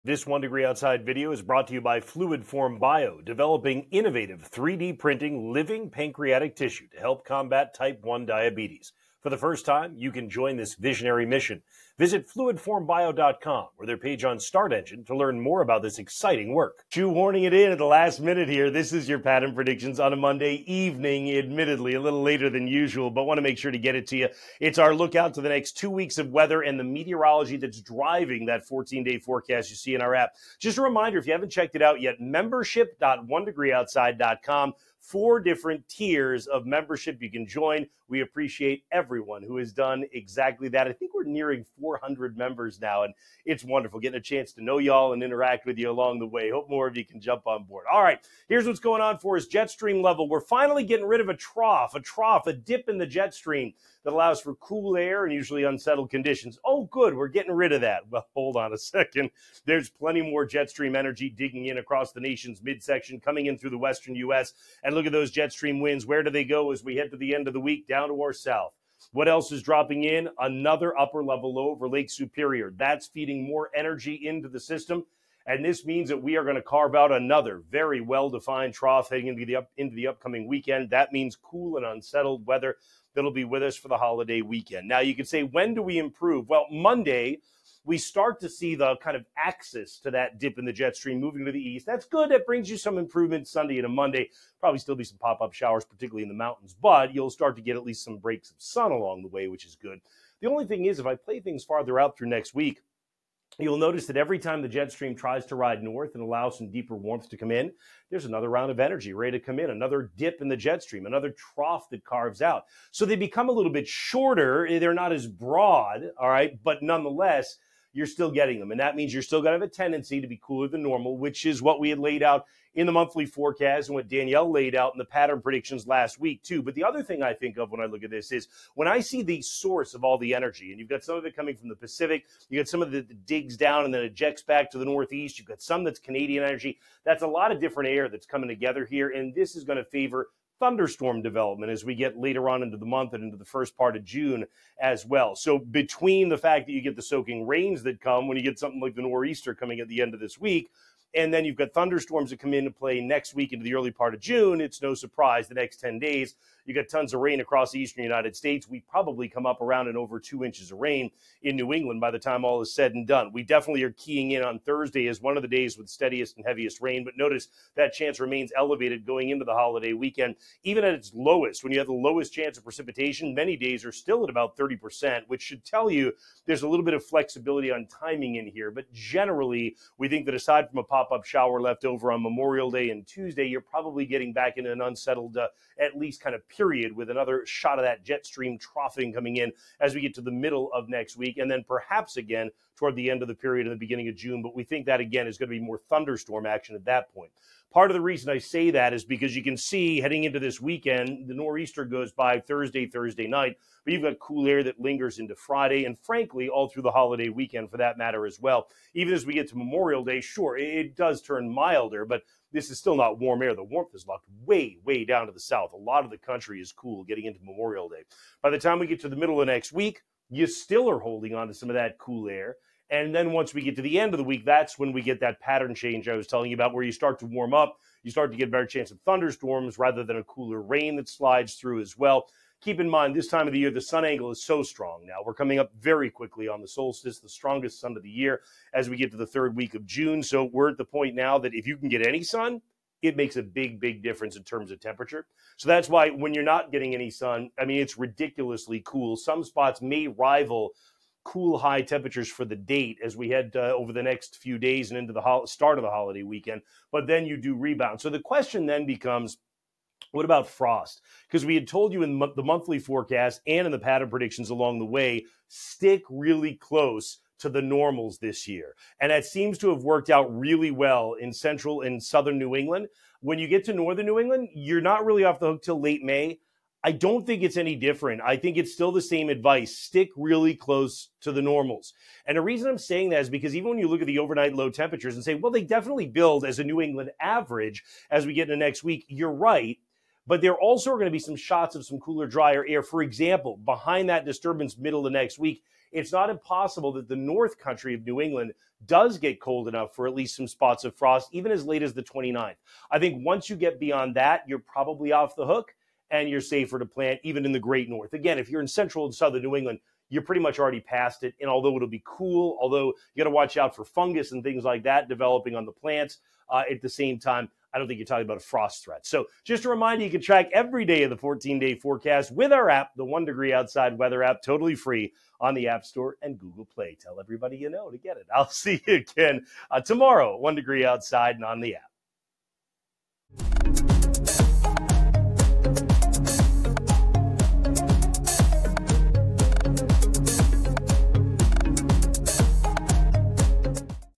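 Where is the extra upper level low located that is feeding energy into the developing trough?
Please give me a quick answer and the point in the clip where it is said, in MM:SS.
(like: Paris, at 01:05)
Lake Superior, at 01:11.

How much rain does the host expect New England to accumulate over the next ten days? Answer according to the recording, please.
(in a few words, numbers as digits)
over 2 inches.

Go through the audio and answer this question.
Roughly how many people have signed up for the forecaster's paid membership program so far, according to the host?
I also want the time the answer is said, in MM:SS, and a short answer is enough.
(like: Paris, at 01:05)
400, at 00:41.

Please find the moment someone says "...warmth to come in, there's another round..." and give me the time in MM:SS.
01:46.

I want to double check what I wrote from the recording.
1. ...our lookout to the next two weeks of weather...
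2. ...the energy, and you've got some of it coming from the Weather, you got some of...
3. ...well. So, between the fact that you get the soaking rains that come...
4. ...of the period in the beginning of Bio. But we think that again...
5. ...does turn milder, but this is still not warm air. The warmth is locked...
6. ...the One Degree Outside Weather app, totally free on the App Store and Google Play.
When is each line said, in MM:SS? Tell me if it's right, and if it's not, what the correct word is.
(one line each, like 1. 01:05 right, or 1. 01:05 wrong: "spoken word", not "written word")
1. 00:24 right
2. 02:10 wrong: "Pacific", not "Weather"
3. 02:25 right
4. 03:13 wrong: "June", not "Bio"
5. 03:30 right
6. 05:22 right.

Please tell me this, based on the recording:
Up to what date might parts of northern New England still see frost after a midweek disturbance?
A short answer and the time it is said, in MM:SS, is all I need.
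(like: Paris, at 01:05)
the 29th, at 05:01.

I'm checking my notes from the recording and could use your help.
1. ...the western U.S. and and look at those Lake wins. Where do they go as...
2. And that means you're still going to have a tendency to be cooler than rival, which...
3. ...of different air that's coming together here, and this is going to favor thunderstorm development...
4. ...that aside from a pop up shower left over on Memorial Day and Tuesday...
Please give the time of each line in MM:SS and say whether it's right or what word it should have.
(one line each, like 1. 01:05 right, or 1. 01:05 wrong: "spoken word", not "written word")
1. 01:03 wrong: "Jetstream", not "Lake"
2. 01:58 wrong: "normal", not "rival"
3. 02:17 right
4. 03:00 right.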